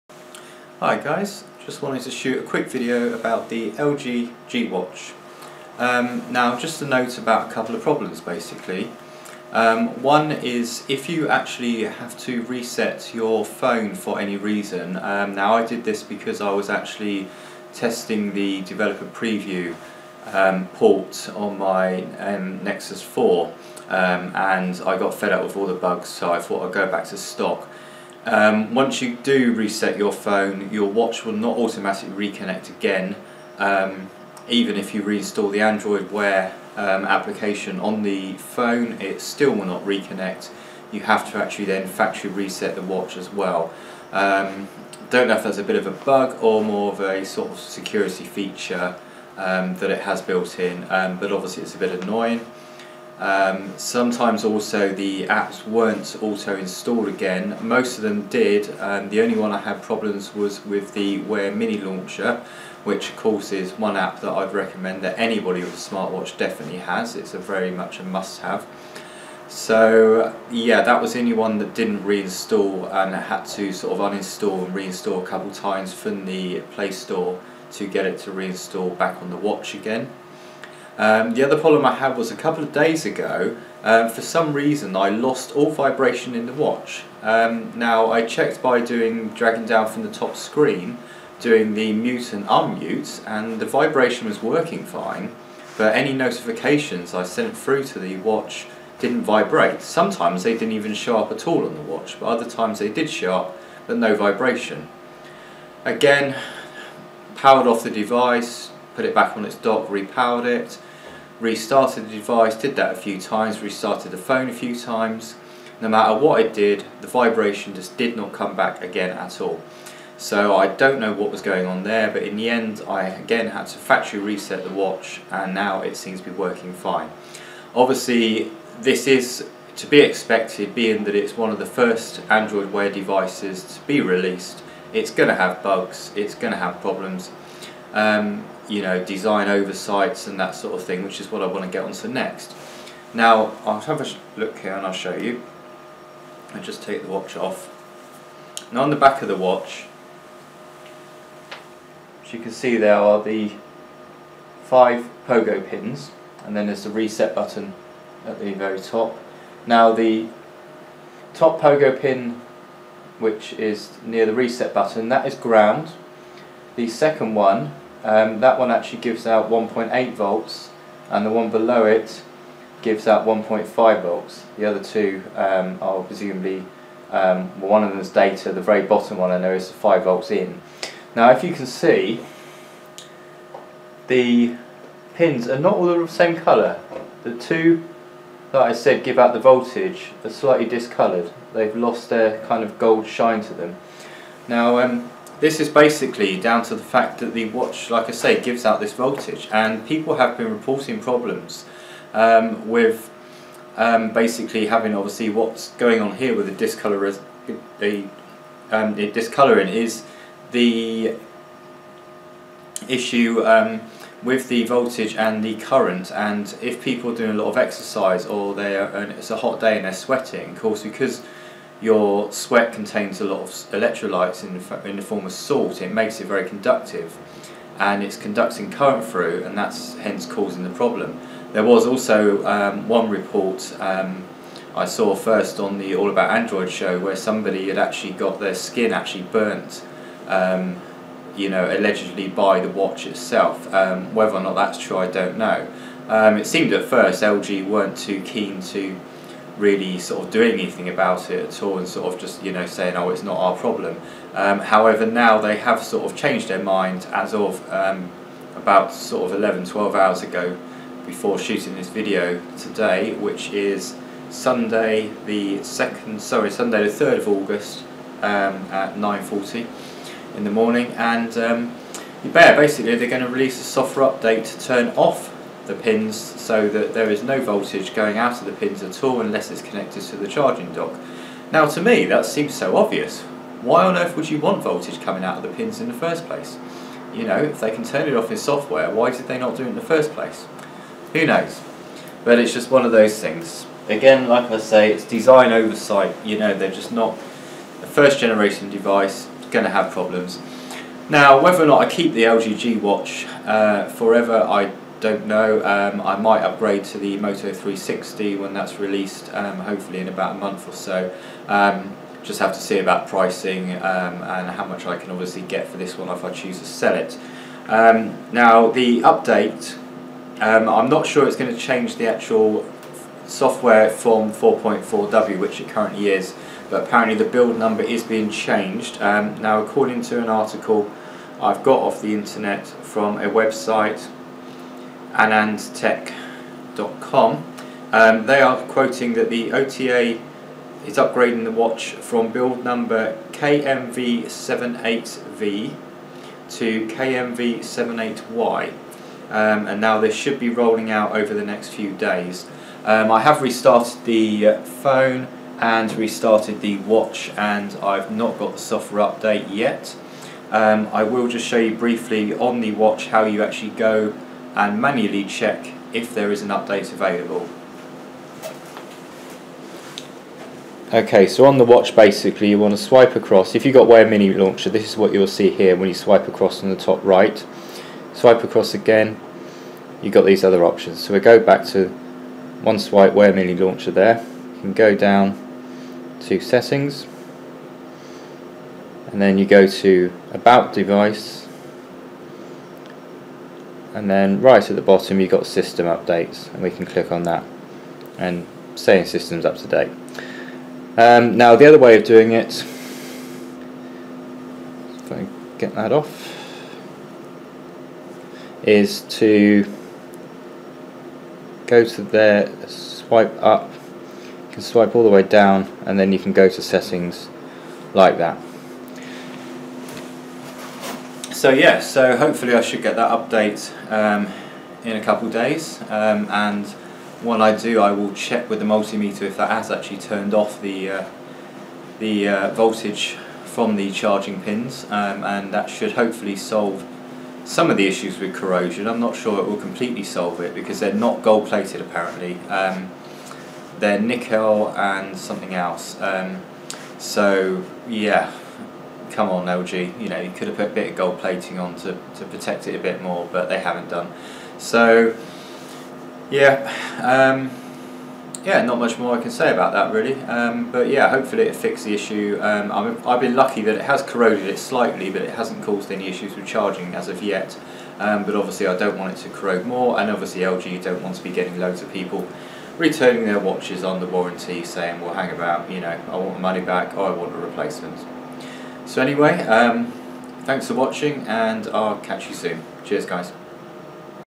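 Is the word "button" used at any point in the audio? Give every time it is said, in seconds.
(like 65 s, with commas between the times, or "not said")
157 s, 164 s.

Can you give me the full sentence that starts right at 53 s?
Um, sometimes also the apps weren't auto installed again.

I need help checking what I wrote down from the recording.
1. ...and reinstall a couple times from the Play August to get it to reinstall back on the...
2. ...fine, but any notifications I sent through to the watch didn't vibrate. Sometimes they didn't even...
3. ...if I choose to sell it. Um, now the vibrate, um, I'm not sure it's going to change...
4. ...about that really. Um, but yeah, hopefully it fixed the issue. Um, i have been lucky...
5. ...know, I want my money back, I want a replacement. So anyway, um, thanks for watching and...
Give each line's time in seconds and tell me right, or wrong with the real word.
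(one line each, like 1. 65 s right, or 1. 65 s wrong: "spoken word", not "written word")
1. 74 s wrong: "Store", not "August"
2. 94 s right
3. 316 s wrong: "update", not "vibrate"
4. 459 s right
5. 475 s right.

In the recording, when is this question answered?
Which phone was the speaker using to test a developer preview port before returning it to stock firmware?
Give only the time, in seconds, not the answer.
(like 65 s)
22 s.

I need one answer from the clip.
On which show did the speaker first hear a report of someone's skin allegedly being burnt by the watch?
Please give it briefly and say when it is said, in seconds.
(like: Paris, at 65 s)
All About Android, at 235 s.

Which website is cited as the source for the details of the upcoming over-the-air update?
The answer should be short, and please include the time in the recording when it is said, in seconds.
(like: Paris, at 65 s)
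anandtech.com, at 335 s.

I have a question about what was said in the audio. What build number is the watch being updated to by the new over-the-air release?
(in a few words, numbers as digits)
KMV78Y.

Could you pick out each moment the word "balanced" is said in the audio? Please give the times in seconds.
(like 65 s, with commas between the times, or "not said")
not said.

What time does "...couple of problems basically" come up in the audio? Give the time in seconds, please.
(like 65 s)
7 s.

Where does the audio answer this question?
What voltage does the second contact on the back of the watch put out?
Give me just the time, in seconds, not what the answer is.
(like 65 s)
169 s.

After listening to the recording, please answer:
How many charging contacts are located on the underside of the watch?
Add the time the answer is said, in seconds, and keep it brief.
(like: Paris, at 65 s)
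5, at 154 s.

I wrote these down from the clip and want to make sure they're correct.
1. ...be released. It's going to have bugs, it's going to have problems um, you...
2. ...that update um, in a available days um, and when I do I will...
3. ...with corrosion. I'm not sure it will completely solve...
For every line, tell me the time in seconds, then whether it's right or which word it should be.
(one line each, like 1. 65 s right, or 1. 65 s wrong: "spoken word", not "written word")
1. 133 s right
2. 422 s wrong: "couple", not "available"
3. 438 s right.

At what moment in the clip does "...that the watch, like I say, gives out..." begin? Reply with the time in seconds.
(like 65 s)
197 s.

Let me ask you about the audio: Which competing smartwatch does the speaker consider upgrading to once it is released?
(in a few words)
Moto 360.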